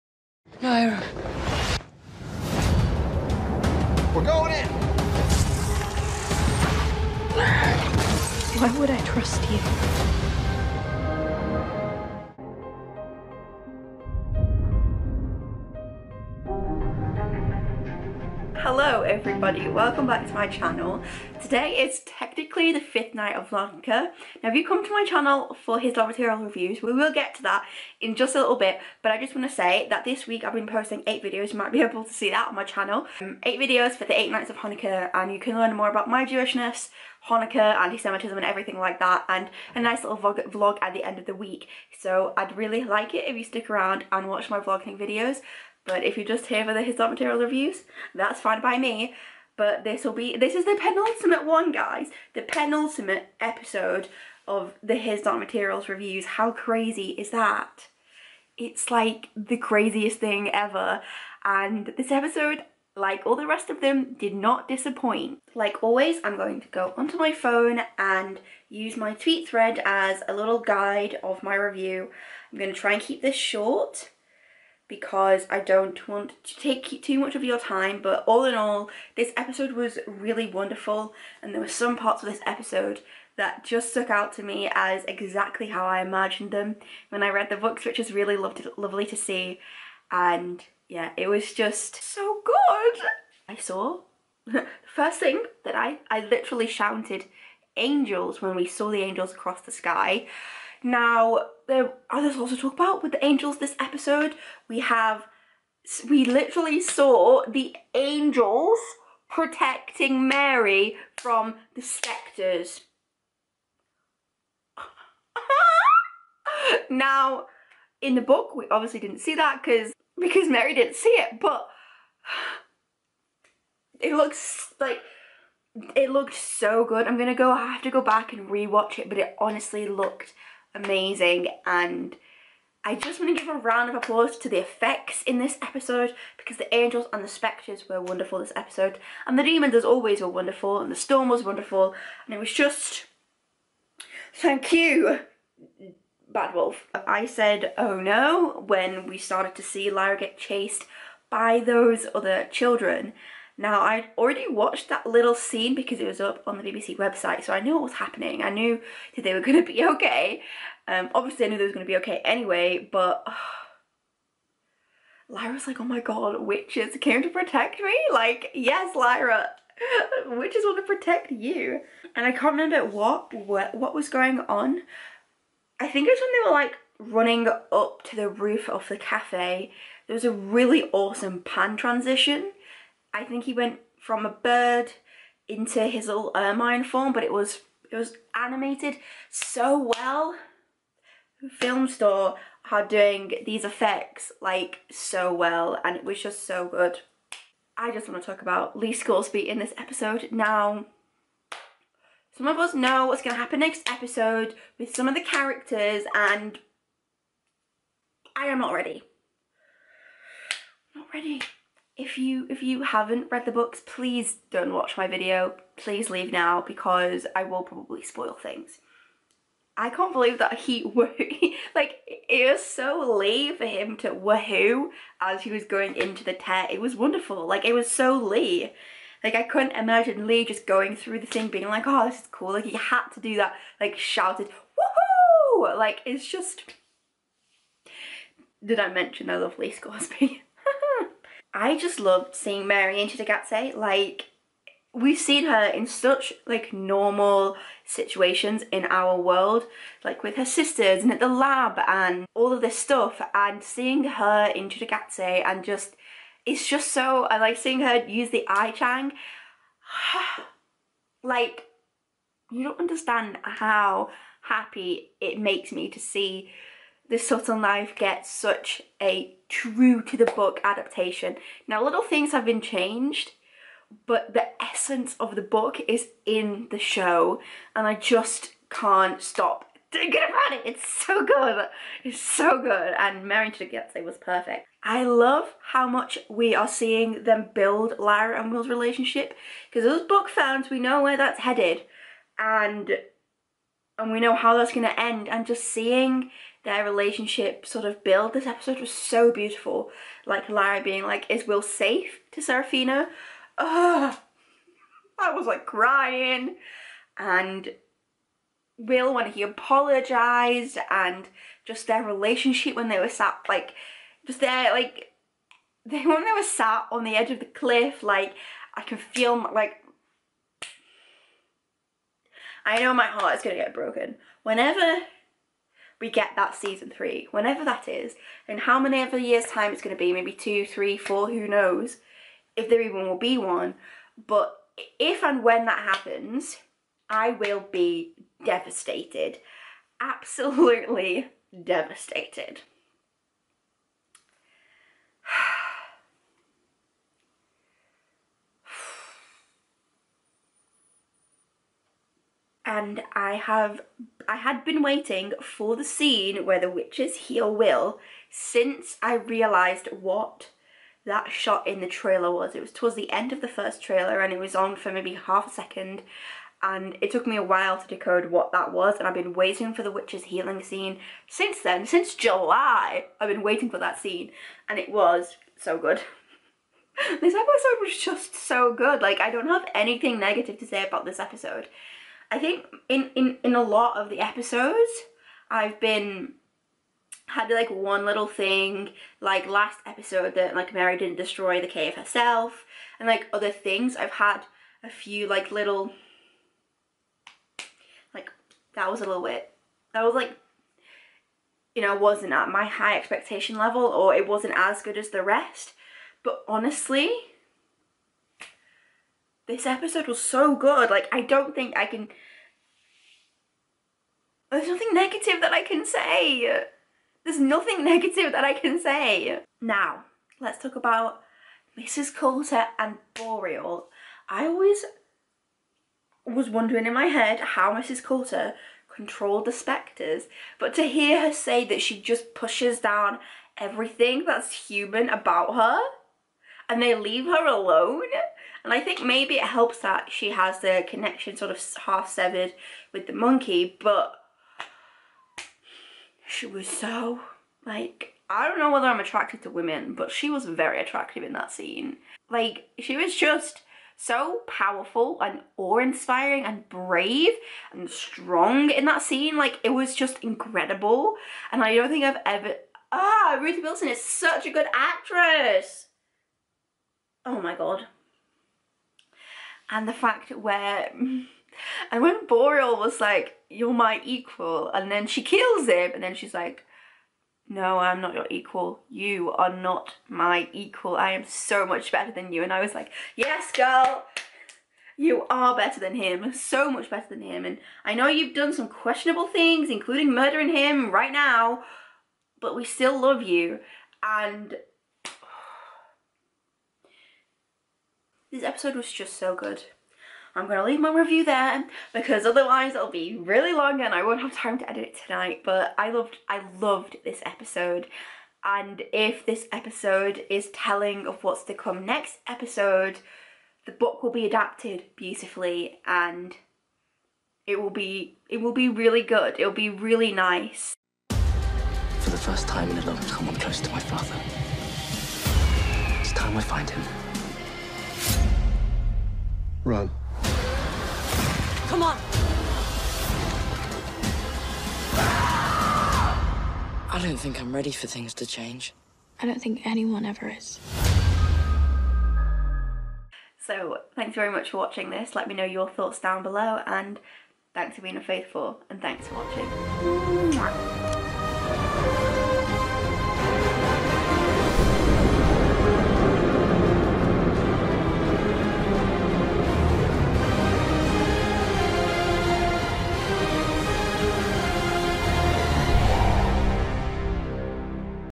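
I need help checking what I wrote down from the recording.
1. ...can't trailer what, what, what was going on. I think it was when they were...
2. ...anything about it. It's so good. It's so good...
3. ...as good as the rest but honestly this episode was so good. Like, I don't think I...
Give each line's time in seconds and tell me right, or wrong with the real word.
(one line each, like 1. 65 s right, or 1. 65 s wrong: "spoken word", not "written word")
1. 172 s wrong: "remember", not "trailer"
2. 279 s wrong: "thinking", not "anything"
3. 404 s right.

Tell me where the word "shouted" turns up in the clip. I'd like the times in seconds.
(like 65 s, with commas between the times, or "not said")
96 s, 233 s.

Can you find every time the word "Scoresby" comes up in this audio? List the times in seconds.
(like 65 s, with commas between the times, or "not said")
198 s, 239 s.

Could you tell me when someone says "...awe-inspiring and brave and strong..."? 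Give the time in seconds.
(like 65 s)
455 s.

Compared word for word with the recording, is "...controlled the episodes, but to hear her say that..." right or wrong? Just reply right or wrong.
wrong.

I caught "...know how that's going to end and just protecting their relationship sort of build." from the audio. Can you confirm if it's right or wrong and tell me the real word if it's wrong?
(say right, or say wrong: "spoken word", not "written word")
wrong: "seeing", not "protecting".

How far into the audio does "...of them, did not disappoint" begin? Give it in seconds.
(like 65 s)
63 s.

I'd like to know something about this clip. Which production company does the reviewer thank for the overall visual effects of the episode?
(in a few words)
Bad Wolf.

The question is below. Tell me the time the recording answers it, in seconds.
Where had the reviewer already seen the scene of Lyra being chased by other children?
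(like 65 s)
156 s.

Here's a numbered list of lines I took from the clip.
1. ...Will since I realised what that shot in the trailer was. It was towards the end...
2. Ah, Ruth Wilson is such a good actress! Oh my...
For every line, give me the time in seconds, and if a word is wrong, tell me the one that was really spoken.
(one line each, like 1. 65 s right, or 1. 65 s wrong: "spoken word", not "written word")
1. 357 s right
2. 462 s right.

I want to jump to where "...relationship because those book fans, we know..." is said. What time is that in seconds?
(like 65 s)
288 s.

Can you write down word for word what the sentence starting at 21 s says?
Today is technically the fifth night of Hanukkah.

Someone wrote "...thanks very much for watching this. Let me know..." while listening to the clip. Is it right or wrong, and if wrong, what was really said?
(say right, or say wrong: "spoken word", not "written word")
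right.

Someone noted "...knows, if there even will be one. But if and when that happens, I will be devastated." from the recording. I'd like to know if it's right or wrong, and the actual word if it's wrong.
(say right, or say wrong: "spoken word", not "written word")
right.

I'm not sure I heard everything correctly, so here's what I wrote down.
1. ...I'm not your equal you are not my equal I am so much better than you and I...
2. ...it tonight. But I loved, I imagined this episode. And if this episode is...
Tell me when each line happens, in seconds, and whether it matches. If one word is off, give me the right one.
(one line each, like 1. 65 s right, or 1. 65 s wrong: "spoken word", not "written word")
1. 477 s right
2. 504 s wrong: "loved", not "imagined".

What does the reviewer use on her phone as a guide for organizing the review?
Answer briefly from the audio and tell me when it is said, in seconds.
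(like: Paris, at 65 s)
tweet thread, at 69 s.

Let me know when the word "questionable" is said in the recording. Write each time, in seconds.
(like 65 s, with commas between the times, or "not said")
488 s.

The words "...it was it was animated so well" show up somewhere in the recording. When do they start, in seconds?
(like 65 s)
187 s.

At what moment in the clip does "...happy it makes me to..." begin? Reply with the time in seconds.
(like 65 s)
264 s.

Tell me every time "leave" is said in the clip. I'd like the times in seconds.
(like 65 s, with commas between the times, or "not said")
216 s, 436 s, 500 s.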